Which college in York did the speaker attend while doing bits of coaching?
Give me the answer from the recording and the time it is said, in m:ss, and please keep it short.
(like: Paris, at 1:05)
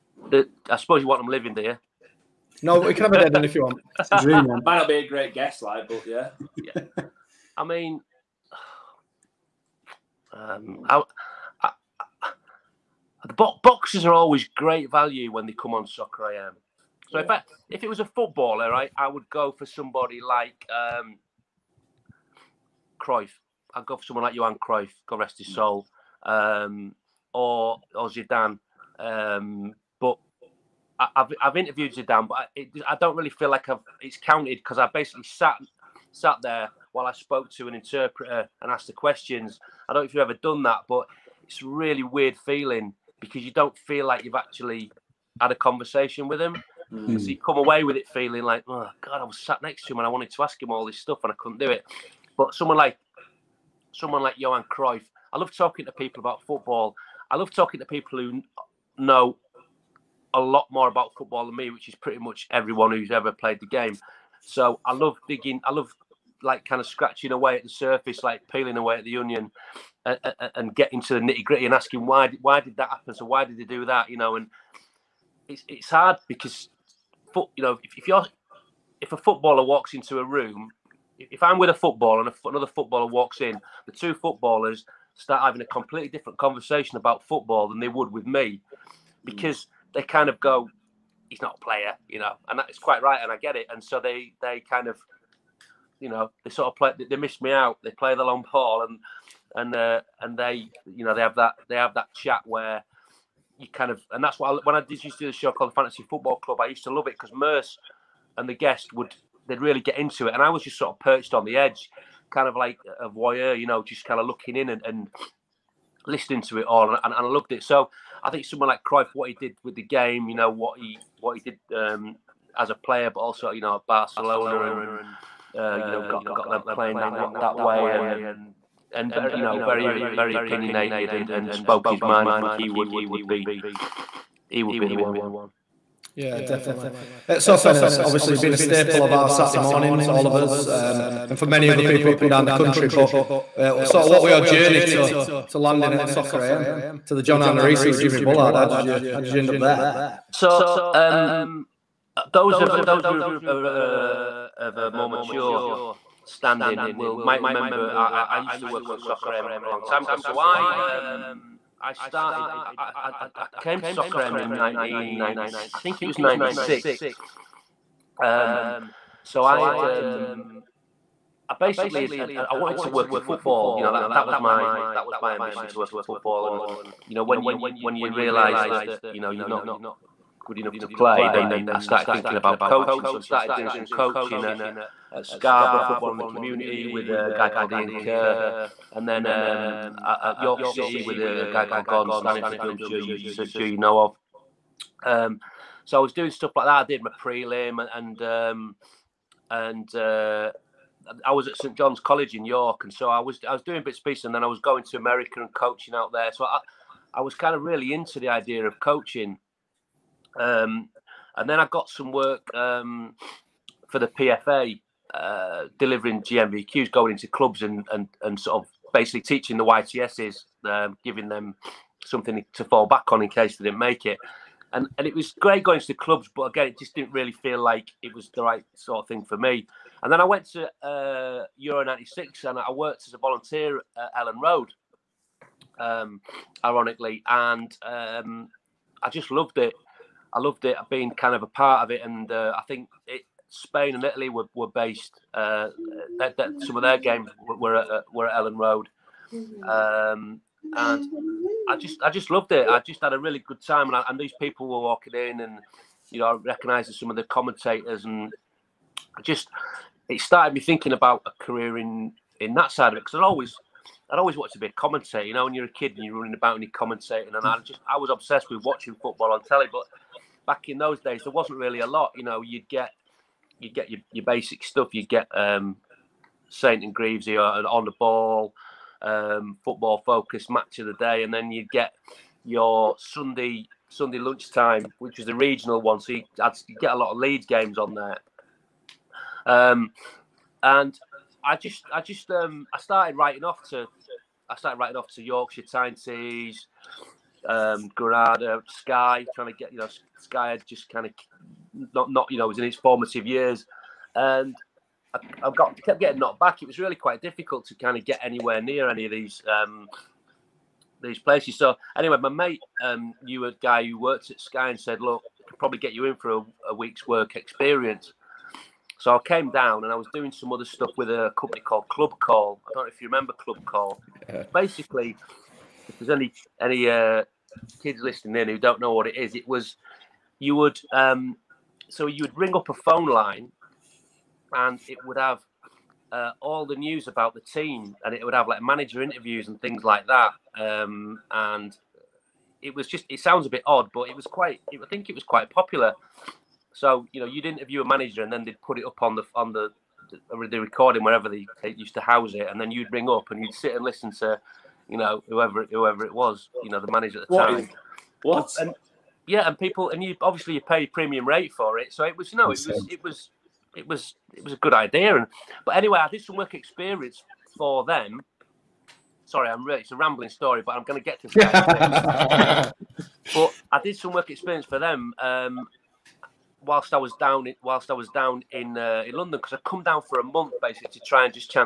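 St John's College, at 3:21.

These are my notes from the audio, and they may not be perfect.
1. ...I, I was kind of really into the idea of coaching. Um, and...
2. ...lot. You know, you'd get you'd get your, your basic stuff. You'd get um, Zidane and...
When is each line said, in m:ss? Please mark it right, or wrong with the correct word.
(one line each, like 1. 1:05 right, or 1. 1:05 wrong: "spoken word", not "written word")
1. 3:26 right
2. 4:31 wrong: "Saint", not "Zidane".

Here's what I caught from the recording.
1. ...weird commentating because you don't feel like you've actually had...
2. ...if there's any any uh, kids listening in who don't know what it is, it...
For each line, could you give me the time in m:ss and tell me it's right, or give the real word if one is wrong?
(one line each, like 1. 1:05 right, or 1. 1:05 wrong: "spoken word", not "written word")
1. 0:42 wrong: "feeling", not "commentating"
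2. 5:25 right.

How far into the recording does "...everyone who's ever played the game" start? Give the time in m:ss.
1:02.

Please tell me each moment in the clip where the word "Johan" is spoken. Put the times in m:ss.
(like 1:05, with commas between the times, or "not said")
0:24, 0:54.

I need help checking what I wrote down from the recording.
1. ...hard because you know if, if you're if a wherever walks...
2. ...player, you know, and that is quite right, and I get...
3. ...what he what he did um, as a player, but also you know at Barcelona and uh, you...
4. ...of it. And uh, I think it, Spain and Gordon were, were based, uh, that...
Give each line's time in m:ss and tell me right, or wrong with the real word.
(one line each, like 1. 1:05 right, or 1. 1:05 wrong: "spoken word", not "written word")
1. 1:15 wrong: "footballer", not "wherever"
2. 1:31 right
3. 2:00 right
4. 4:01 wrong: "Italy", not "Gordon".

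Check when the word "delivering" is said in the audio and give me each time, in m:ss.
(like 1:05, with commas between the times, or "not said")
3:35.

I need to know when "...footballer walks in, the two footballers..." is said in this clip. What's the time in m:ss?
1:22.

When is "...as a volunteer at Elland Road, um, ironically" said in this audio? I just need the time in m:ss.
3:53.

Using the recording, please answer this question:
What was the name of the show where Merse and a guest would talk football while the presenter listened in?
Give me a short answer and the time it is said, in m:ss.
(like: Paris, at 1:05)
Fantasy Football Club, at 1:45.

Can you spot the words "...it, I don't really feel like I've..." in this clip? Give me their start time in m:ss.
0:32.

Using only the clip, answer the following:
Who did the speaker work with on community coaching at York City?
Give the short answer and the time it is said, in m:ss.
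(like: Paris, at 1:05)
Gordon Staniforth, at 3:11.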